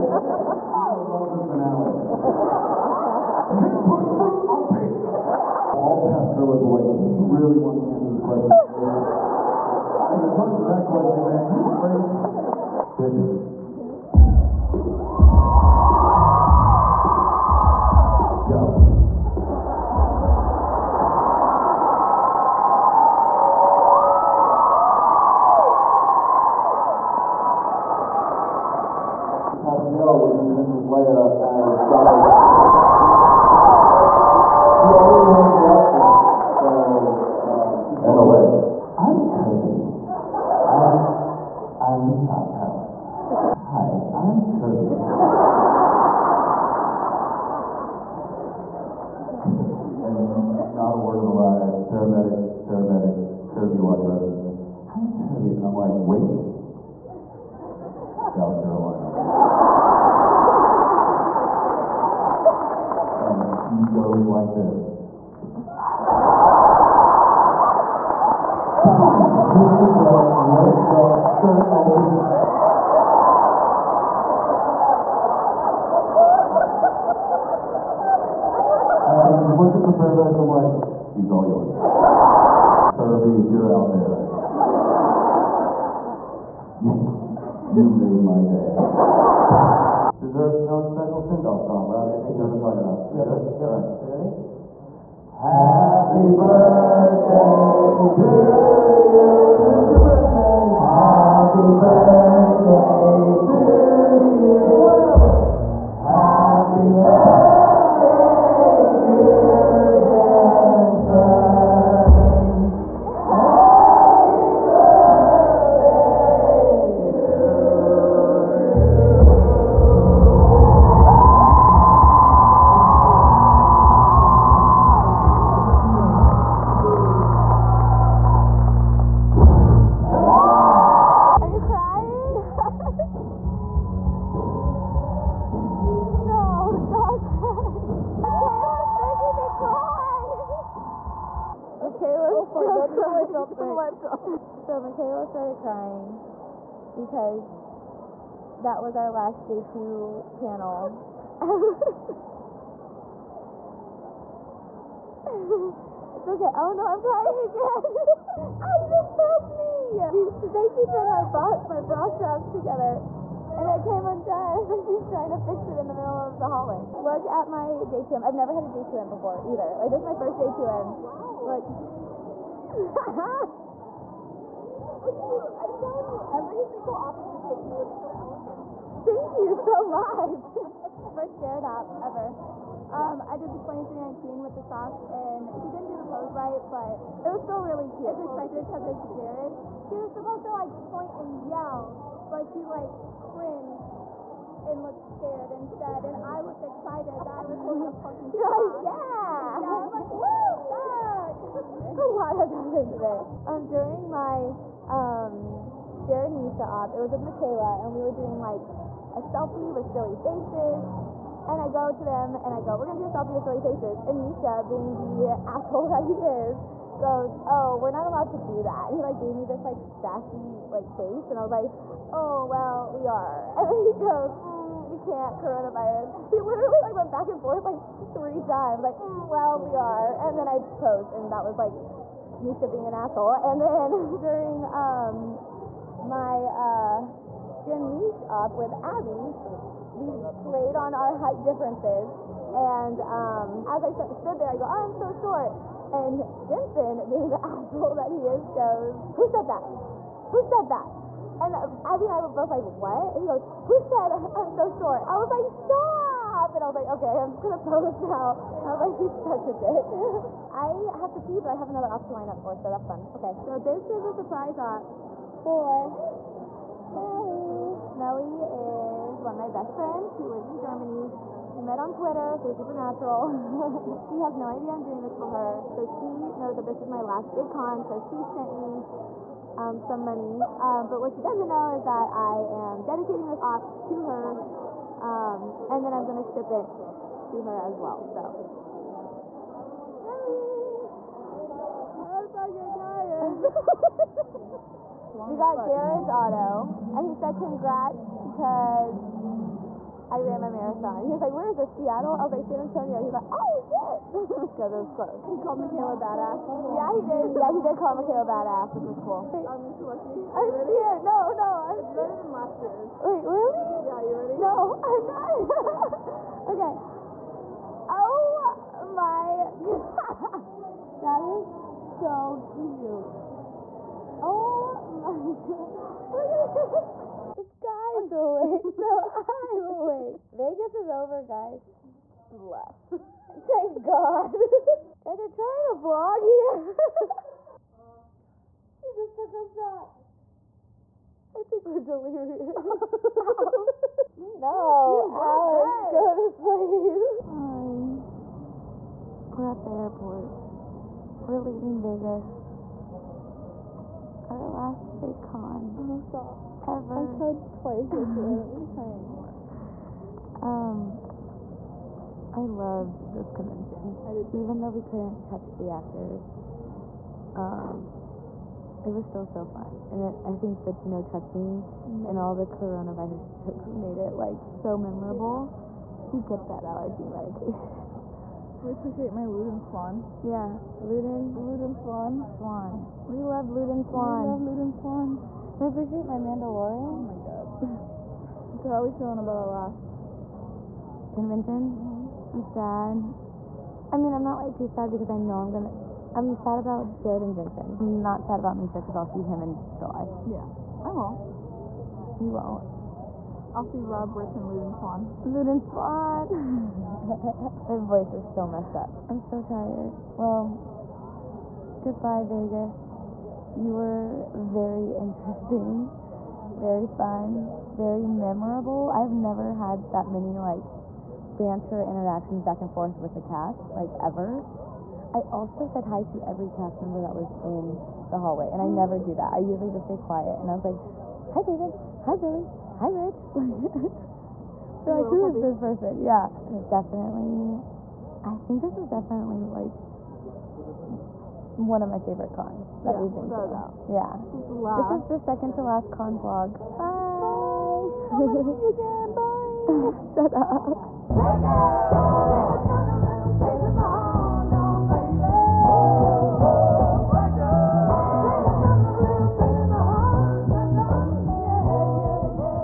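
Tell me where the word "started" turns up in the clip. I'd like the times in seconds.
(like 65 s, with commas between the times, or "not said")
145 s.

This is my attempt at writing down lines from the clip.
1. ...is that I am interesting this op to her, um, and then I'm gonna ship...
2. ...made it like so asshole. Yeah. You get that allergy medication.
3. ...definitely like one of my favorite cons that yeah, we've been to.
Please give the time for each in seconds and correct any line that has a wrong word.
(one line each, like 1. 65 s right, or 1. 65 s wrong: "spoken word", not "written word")
1. 281 s wrong: "dedicating", not "interesting"
2. 373 s wrong: "memorable", not "asshole"
3. 438 s right.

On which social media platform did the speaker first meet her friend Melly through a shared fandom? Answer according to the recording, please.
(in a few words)
Twitter.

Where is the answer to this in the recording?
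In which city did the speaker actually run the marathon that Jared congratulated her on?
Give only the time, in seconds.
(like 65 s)
302 s.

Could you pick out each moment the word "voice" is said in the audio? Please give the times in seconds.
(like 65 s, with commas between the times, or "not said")
407 s.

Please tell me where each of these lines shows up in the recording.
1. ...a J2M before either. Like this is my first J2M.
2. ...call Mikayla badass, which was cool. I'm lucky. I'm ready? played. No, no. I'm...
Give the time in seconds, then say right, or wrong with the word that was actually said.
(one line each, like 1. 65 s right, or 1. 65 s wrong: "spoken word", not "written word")
1. 168 s right
2. 307 s wrong: "scared", not "played".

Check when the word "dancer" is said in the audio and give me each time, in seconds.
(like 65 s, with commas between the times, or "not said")
109 s.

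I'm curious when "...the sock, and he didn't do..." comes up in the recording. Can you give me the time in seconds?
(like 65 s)
184 s.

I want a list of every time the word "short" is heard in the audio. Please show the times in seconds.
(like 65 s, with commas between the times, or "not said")
245 s, 254 s.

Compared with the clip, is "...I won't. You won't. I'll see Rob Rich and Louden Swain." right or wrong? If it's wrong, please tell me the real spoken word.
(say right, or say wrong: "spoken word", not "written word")
right.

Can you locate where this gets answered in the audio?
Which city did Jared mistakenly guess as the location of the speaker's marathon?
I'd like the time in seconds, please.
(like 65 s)
301 s.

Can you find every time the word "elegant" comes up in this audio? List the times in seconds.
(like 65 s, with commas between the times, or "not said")
178 s.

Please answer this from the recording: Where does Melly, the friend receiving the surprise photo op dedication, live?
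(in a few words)
Germany.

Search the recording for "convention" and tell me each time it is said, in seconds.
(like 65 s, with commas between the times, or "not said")
363 s, 391 s.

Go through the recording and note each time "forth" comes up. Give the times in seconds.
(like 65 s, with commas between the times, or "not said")
227 s, 422 s.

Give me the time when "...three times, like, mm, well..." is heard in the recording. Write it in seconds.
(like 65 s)
228 s.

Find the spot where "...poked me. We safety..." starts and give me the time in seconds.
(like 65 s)
159 s.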